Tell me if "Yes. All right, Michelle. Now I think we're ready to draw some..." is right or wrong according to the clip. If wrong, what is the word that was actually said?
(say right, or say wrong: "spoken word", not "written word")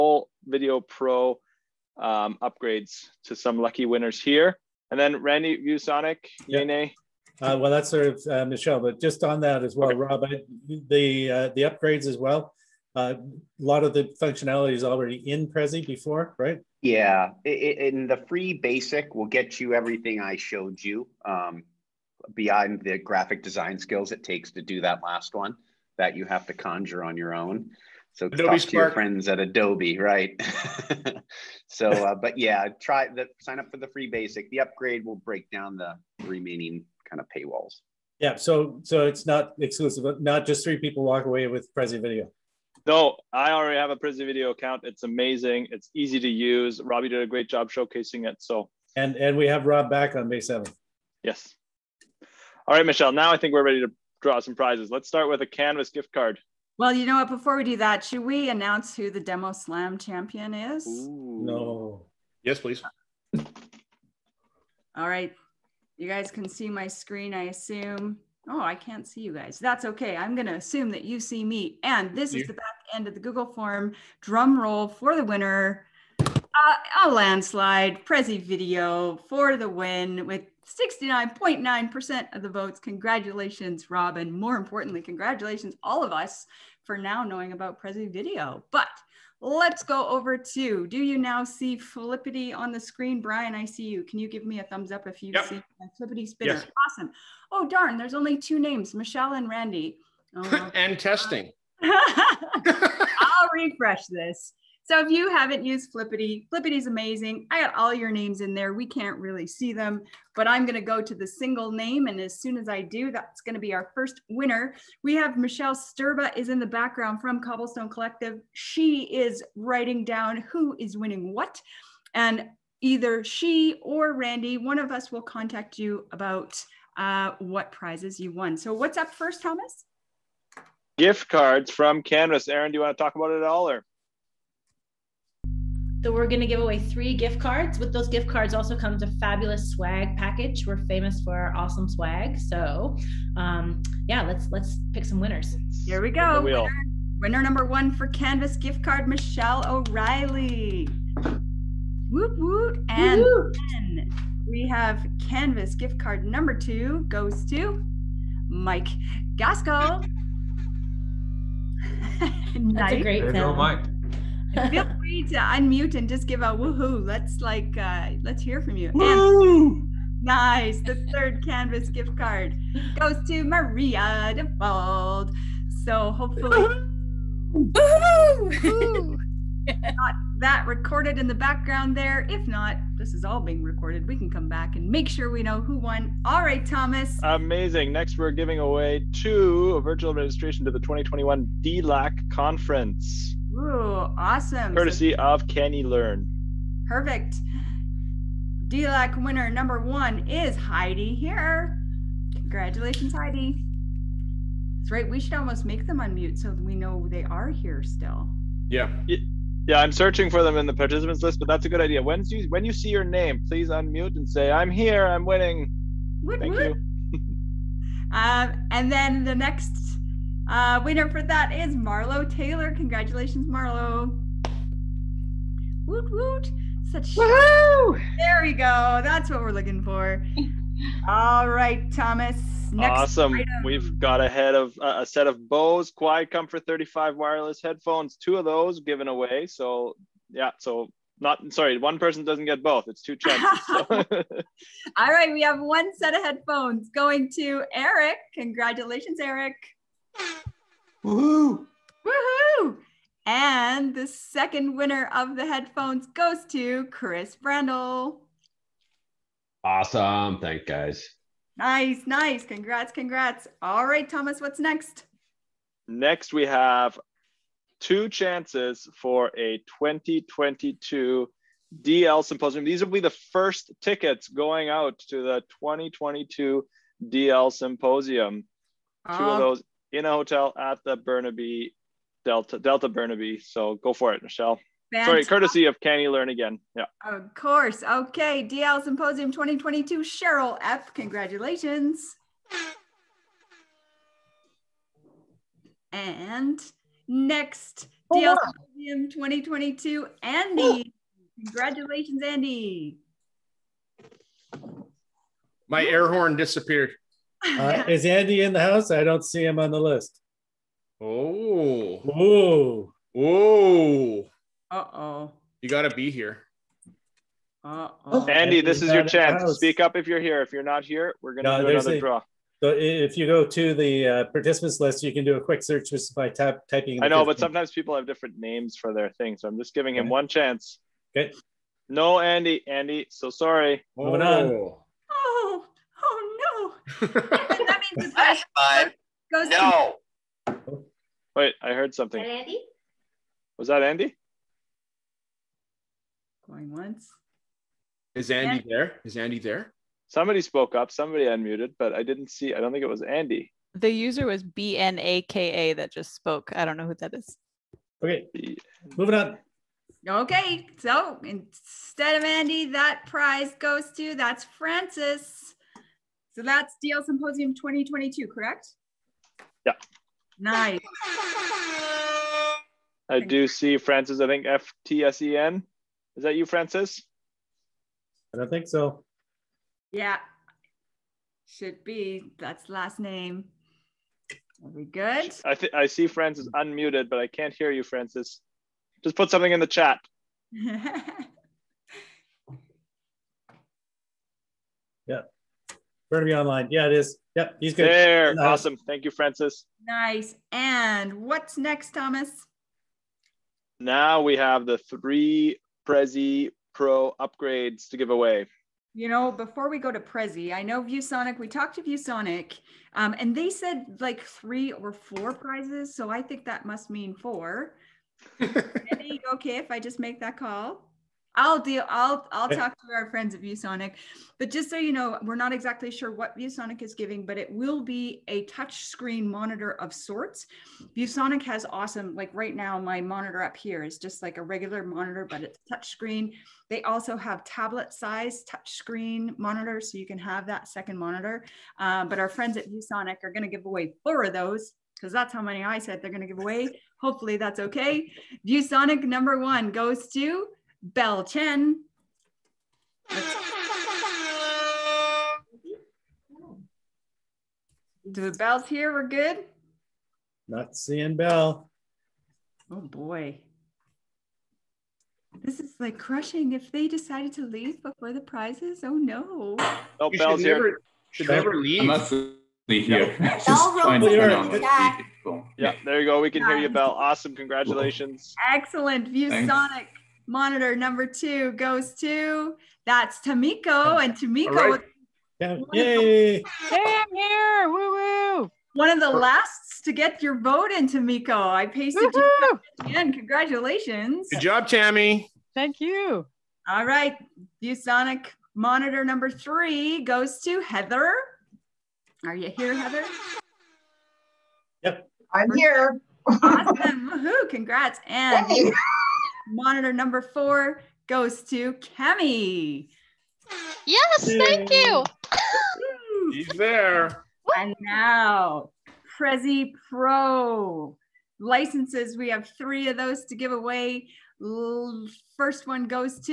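right.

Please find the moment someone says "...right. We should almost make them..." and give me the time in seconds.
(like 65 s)
204 s.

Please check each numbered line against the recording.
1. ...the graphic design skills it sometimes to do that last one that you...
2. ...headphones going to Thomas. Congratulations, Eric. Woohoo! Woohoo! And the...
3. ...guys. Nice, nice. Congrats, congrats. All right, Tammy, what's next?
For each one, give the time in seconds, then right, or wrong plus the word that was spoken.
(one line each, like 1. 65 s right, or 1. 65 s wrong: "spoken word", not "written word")
1. 22 s wrong: "takes", not "sometimes"
2. 246 s wrong: "Eric", not "Thomas"
3. 260 s wrong: "Thomas", not "Tammy".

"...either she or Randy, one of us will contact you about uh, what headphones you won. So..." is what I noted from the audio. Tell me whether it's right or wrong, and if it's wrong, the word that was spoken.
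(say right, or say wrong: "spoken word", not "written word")
wrong: "prizes", not "headphones".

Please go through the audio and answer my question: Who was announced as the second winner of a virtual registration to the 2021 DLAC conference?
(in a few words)
Marlo Taylor.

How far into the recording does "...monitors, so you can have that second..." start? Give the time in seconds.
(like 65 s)
439 s.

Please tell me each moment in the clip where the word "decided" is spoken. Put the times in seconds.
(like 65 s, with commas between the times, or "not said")
466 s.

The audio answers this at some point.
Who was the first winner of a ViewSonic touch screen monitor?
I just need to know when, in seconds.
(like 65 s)
450 s.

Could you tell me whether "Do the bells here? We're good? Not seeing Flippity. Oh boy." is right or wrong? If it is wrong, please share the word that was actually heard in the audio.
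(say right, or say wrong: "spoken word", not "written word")
wrong: "Bell", not "Flippity".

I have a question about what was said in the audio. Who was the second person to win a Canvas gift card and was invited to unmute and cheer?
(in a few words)
Mike Gasco.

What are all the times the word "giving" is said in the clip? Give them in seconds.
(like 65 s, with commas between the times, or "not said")
188 s, 329 s, 426 s.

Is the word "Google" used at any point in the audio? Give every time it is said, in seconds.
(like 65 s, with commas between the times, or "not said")
73 s.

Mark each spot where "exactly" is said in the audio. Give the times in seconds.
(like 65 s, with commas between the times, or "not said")
425 s.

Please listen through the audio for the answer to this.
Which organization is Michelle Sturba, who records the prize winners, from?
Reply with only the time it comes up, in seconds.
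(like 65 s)
117 s.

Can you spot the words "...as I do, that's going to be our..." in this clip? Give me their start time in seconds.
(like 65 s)
112 s.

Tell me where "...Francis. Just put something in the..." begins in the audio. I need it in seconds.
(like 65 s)
387 s.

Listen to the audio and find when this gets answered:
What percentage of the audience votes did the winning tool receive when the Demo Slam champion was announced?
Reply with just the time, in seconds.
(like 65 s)
80 s.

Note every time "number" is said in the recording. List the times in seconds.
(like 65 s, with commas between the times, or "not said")
147 s, 156 s, 199 s, 449 s, 480 s, 499 s, 509 s.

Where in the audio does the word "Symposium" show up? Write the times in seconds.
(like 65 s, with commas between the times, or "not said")
272 s, 277 s, 288 s, 298 s, 367 s.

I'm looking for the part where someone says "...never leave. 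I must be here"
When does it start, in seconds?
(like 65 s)
471 s.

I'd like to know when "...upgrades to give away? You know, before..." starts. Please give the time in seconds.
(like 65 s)
407 s.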